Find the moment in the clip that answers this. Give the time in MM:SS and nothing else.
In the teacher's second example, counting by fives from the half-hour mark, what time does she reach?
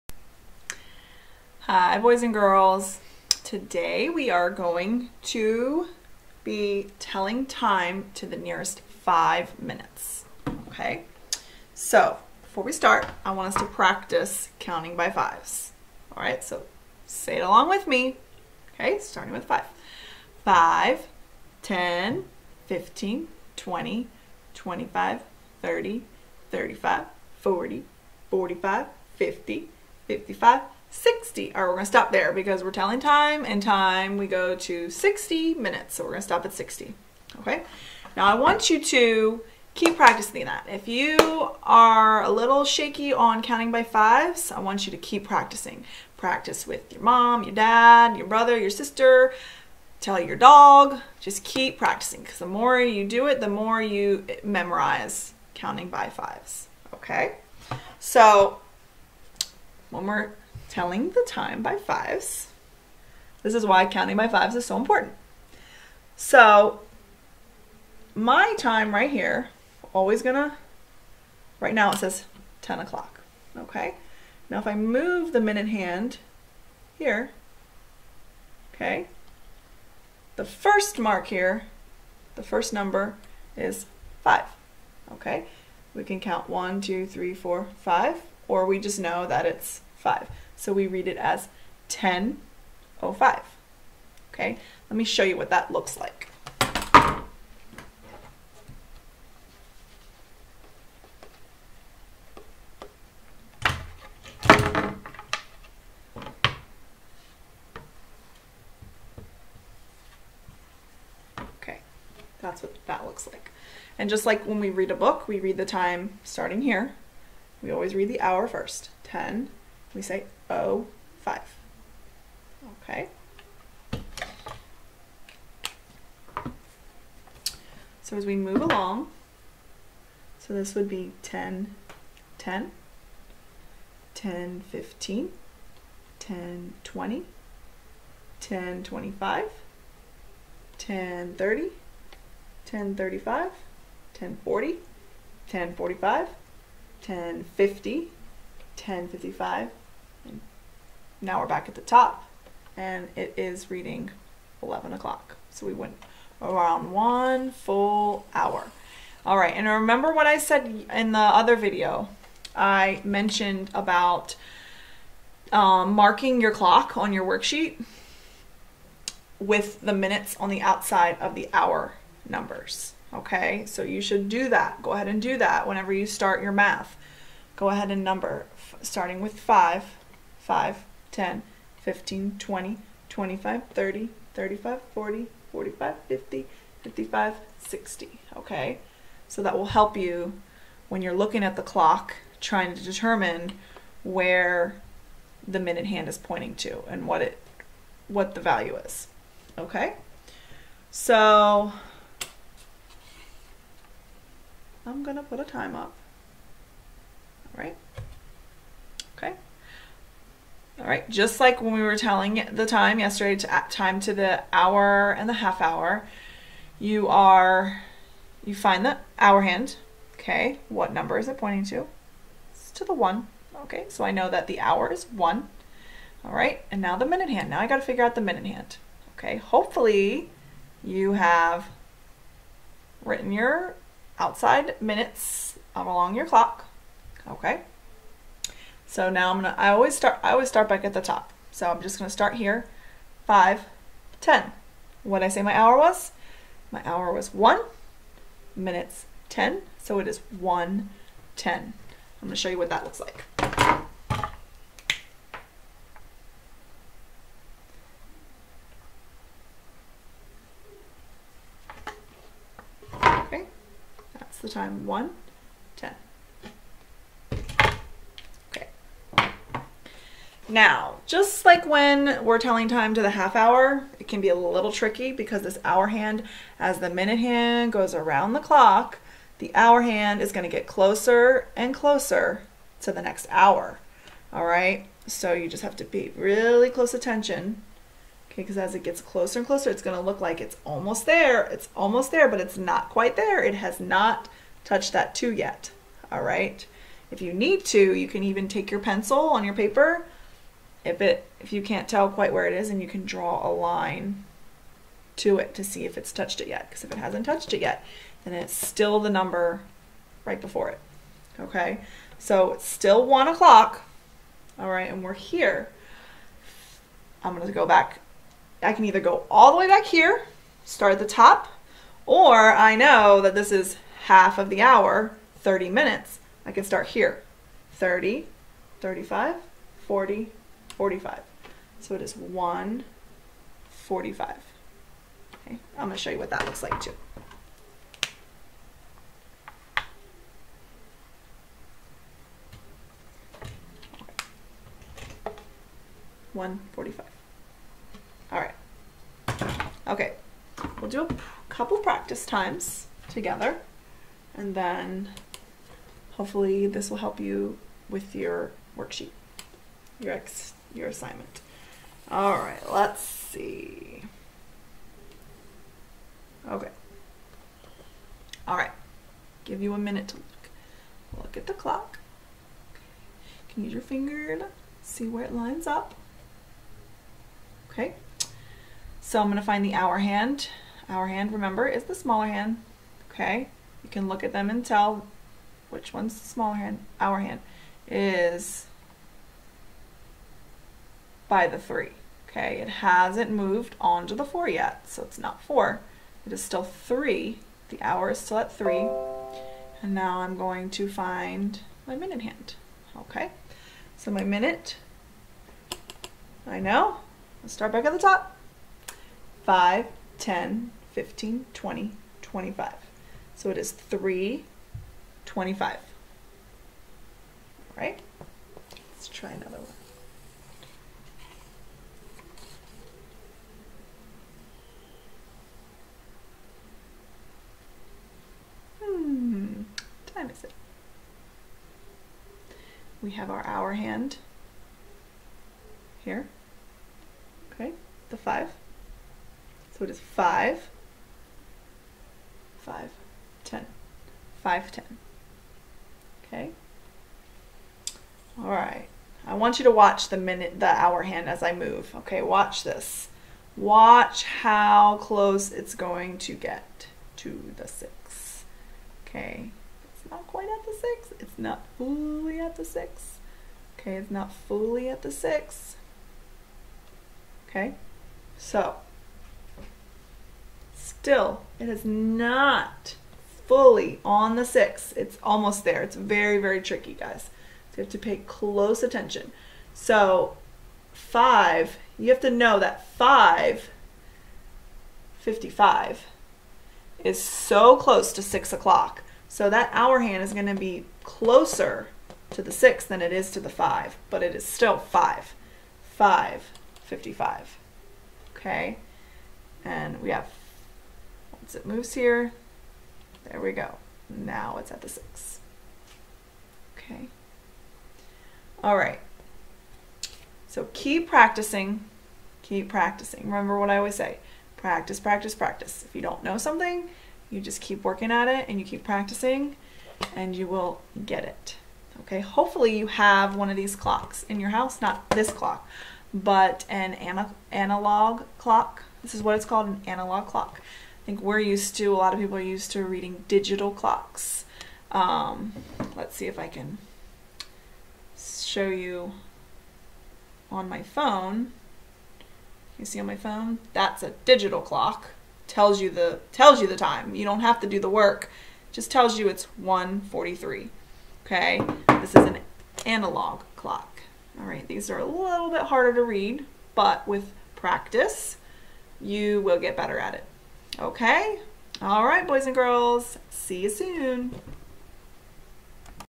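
05:32.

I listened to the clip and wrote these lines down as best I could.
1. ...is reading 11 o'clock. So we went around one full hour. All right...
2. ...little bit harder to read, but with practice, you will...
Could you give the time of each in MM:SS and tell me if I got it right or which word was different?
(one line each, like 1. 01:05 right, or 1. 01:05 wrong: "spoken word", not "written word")
1. 02:33 right
2. 09:15 right.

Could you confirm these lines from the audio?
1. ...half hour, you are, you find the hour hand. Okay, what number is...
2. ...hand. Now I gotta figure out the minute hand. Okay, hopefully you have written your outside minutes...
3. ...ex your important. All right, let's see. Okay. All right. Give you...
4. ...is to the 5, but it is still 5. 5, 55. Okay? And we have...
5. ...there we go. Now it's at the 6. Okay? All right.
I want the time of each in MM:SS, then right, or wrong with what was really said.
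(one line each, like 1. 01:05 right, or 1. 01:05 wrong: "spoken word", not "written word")
1. 03:35 right
2. 03:47 right
3. 06:00 wrong: "assignment", not "important"
4. 08:13 right
5. 08:23 right.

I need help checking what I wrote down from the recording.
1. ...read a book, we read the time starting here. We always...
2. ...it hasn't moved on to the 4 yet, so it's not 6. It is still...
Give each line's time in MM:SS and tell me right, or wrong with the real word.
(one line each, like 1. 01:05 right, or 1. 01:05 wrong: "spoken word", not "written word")
1. 01:54 right
2. 06:32 wrong: "4", not "6".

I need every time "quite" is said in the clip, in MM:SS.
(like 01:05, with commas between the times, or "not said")
04:52, 05:02, 07:40.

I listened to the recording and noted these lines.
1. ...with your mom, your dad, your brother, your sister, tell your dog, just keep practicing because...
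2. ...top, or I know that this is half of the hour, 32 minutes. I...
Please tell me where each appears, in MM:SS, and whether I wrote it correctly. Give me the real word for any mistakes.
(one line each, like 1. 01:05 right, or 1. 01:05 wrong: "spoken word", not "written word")
1. 00:46 right
2. 05:21 wrong: "30", not "32".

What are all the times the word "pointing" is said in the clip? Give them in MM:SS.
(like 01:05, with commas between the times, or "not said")
03:16, 03:41.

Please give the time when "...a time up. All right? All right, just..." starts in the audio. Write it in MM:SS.
03:25.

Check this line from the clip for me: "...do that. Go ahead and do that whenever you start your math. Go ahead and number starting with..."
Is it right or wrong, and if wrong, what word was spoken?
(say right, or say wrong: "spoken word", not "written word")
right.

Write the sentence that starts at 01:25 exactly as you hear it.
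We can count one, two, three, four, five, or we just know that it's five.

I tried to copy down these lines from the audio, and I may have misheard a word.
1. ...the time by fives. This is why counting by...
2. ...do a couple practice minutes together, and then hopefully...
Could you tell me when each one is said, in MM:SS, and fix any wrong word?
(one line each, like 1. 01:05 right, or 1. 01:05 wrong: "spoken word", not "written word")
1. 01:01 right
2. 05:50 wrong: "times", not "minutes".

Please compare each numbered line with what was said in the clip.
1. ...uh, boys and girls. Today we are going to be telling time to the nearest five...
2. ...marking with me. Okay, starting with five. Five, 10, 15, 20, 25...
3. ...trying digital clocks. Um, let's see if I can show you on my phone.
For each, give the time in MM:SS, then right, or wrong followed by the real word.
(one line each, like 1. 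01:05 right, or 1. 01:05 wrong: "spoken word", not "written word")
1. 00:01 right
2. 00:17 wrong: "along", not "marking"
3. 08:52 wrong: "reading", not "trying".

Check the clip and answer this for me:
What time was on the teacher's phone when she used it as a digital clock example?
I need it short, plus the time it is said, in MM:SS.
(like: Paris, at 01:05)
1:43, at 09:09.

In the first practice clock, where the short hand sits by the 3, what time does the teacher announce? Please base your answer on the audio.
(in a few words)
3:25.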